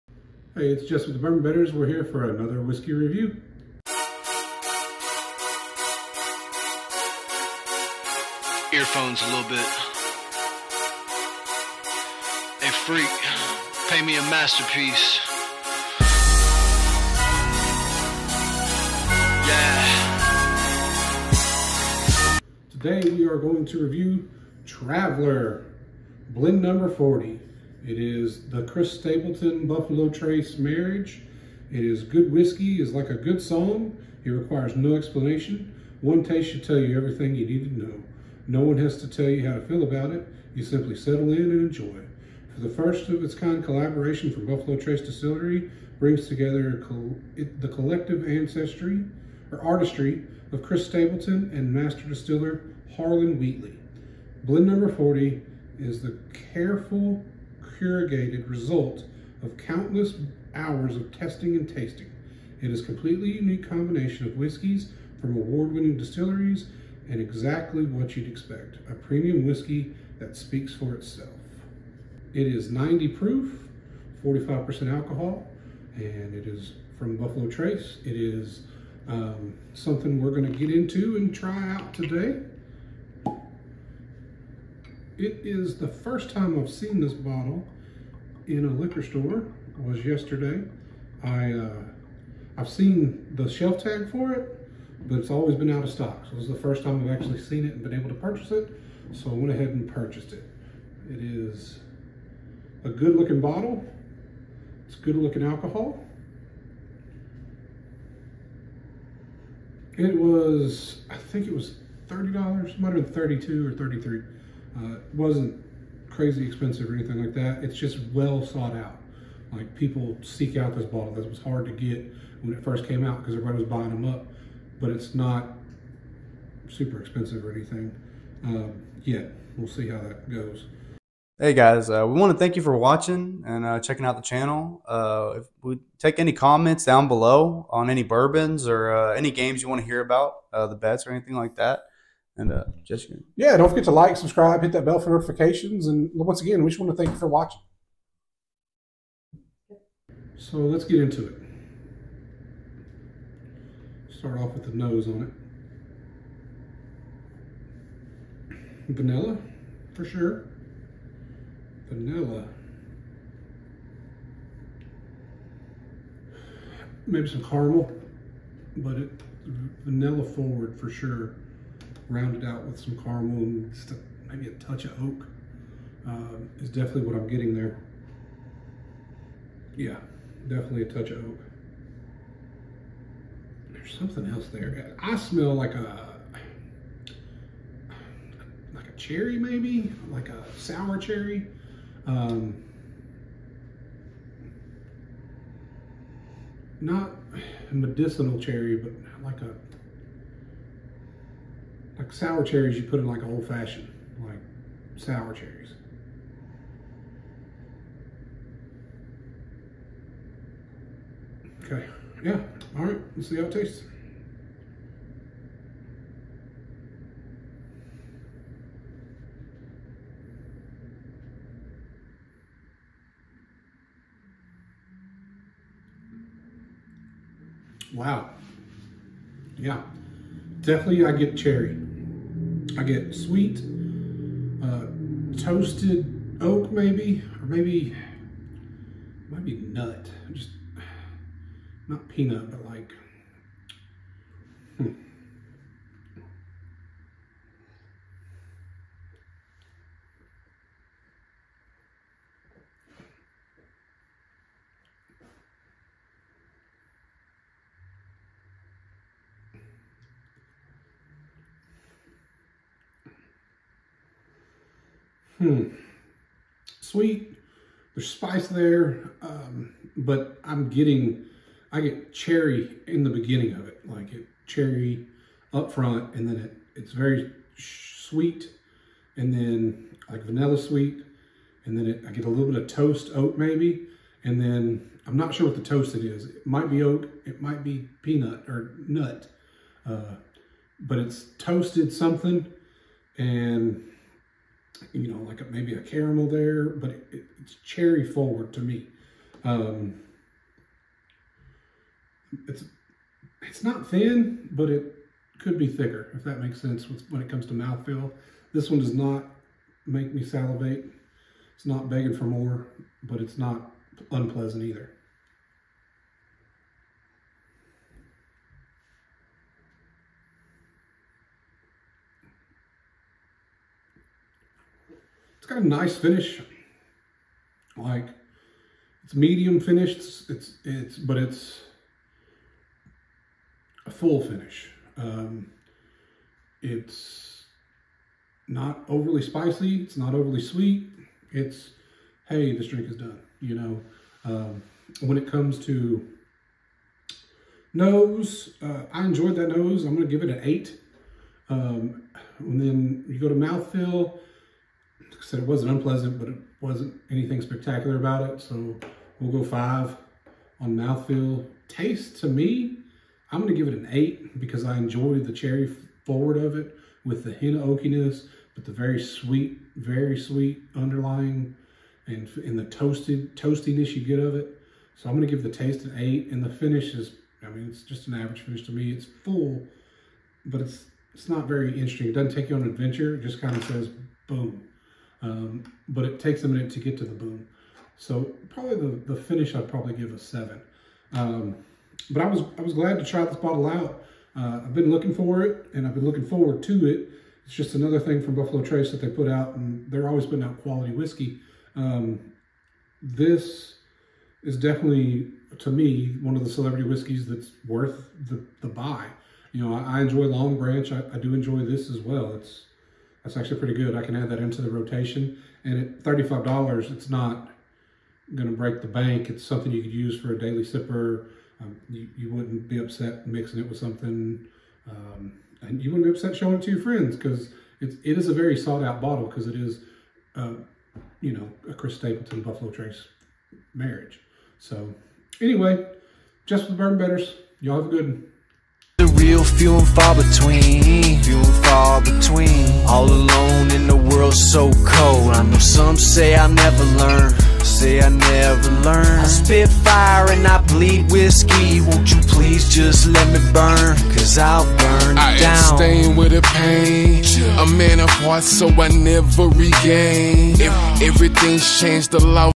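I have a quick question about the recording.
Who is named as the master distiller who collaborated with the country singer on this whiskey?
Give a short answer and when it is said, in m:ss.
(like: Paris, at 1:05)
Harlan Wheatley, at 0:52.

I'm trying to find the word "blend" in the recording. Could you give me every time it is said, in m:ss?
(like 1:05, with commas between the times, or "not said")
0:26, 0:54.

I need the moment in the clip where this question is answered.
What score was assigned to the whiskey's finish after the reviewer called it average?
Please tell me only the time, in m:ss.
6:29.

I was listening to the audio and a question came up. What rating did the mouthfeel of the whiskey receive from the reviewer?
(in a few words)
5.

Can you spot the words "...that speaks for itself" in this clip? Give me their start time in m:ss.
1:10.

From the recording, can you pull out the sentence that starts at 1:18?
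It is um, something we're gonna get into and try out today.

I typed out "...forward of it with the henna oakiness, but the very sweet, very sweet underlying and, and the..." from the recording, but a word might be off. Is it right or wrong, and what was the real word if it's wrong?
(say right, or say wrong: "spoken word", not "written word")
right.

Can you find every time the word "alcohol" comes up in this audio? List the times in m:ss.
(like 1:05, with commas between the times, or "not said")
1:14, 1:45.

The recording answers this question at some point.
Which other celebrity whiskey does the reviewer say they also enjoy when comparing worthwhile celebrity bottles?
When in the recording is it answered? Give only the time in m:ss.
6:50.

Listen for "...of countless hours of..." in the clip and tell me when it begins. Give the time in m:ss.
0:59.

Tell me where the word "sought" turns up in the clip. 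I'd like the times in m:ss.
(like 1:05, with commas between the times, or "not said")
1:58, 7:08.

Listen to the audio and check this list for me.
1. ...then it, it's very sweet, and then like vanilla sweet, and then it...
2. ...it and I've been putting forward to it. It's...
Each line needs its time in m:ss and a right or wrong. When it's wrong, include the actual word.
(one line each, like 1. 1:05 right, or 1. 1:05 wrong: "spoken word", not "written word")
1. 4:36 right
2. 6:35 wrong: "looking", not "putting".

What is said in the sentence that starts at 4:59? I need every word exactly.
Um, it's it's not thin, but it could be thicker, if that makes sense when it comes to mouthfeel.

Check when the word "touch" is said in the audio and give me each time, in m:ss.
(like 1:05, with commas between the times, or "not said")
2:54, 3:00.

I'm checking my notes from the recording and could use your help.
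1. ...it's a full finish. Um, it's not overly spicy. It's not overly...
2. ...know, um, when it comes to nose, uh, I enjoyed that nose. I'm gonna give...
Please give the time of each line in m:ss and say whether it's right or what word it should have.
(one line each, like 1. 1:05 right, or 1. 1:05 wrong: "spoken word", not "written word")
1. 5:31 right
2. 5:43 right.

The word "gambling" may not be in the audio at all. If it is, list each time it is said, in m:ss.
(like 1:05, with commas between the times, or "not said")
not said.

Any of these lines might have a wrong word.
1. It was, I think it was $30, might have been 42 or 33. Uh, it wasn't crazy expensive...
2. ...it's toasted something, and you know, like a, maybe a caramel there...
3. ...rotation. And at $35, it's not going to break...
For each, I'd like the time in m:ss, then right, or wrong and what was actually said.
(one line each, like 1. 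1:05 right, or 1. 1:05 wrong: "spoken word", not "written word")
1. 1:49 wrong: "32", not "42"
2. 4:50 right
3. 6:54 right.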